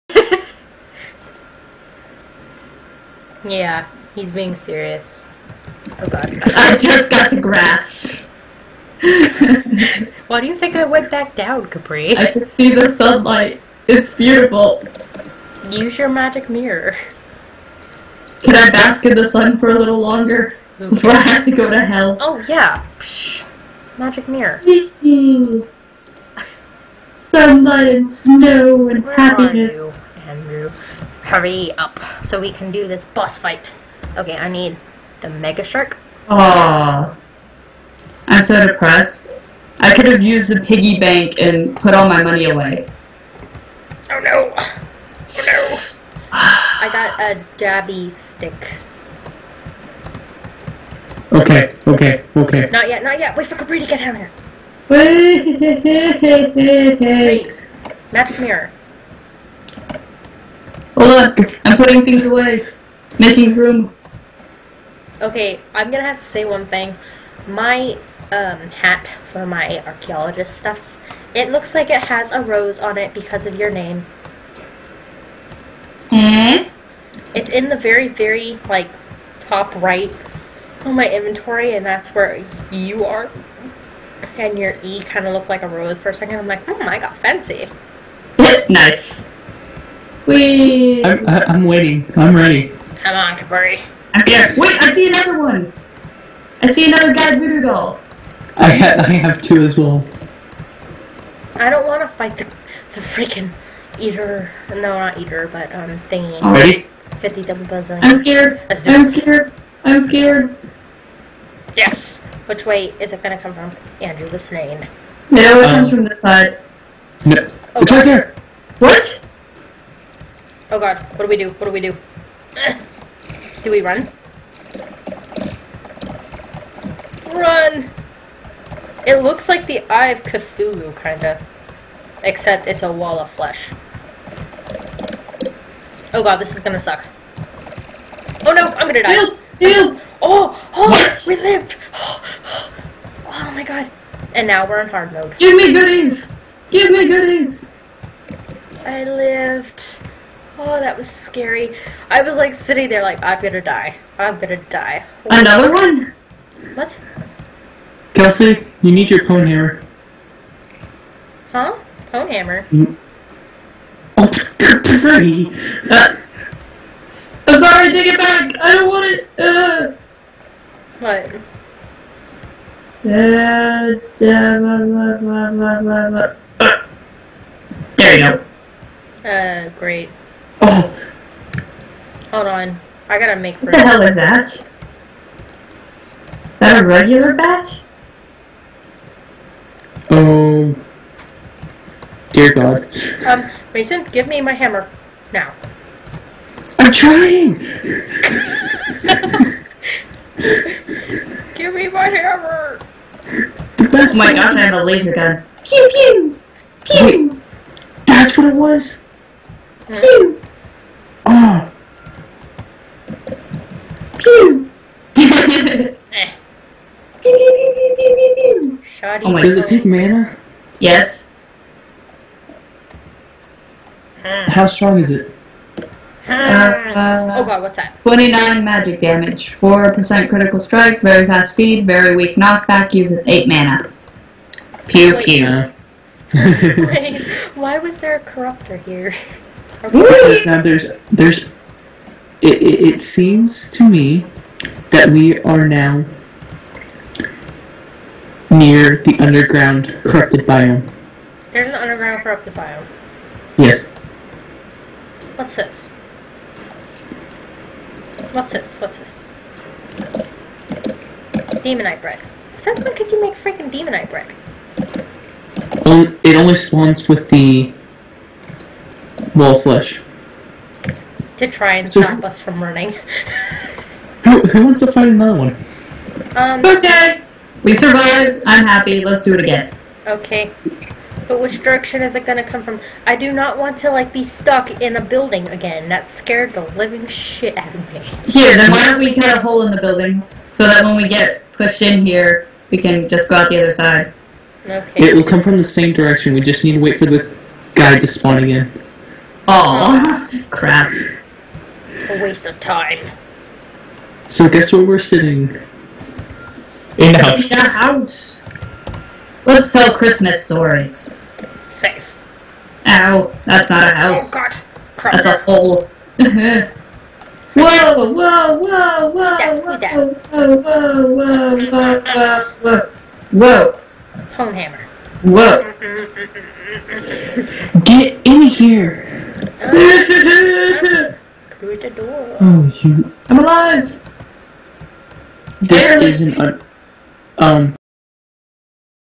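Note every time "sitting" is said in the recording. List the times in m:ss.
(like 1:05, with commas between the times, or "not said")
2:32, 5:04.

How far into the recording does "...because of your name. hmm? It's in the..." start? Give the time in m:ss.
1:13.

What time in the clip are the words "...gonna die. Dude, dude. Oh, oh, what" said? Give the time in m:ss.
2:18.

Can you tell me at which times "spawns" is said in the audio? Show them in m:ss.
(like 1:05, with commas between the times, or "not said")
4:26, 4:58.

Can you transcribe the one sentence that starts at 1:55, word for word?
No, it um, comes from the side.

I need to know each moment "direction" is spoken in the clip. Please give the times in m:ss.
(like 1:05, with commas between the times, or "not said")
4:41, 4:55.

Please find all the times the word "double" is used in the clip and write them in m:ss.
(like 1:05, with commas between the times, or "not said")
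1:47.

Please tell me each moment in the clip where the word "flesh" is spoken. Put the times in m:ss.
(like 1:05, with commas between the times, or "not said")
2:13, 4:29.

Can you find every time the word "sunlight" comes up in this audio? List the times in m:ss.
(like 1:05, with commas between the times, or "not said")
0:12, 0:27.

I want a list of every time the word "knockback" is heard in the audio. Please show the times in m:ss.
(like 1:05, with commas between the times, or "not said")
3:52.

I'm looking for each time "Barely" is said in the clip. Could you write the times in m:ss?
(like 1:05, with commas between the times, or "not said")
5:35.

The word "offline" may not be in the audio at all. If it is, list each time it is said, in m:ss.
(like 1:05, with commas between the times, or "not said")
not said.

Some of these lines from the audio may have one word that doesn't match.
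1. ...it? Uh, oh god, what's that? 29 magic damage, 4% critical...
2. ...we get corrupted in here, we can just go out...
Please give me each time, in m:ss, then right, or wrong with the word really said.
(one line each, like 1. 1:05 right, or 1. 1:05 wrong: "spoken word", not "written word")
1. 3:45 right
2. 4:50 wrong: "pushed", not "corrupted".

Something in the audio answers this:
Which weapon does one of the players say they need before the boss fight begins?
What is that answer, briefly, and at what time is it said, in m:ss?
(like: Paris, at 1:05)
Megashark, at 0:35.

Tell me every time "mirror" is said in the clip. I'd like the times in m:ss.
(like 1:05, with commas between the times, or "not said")
0:16, 0:24, 0:58.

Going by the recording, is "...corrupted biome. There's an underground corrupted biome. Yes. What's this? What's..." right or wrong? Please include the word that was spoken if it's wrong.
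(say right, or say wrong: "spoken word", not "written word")
right.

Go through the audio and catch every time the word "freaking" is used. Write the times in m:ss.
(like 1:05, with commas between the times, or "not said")
1:43, 4:23.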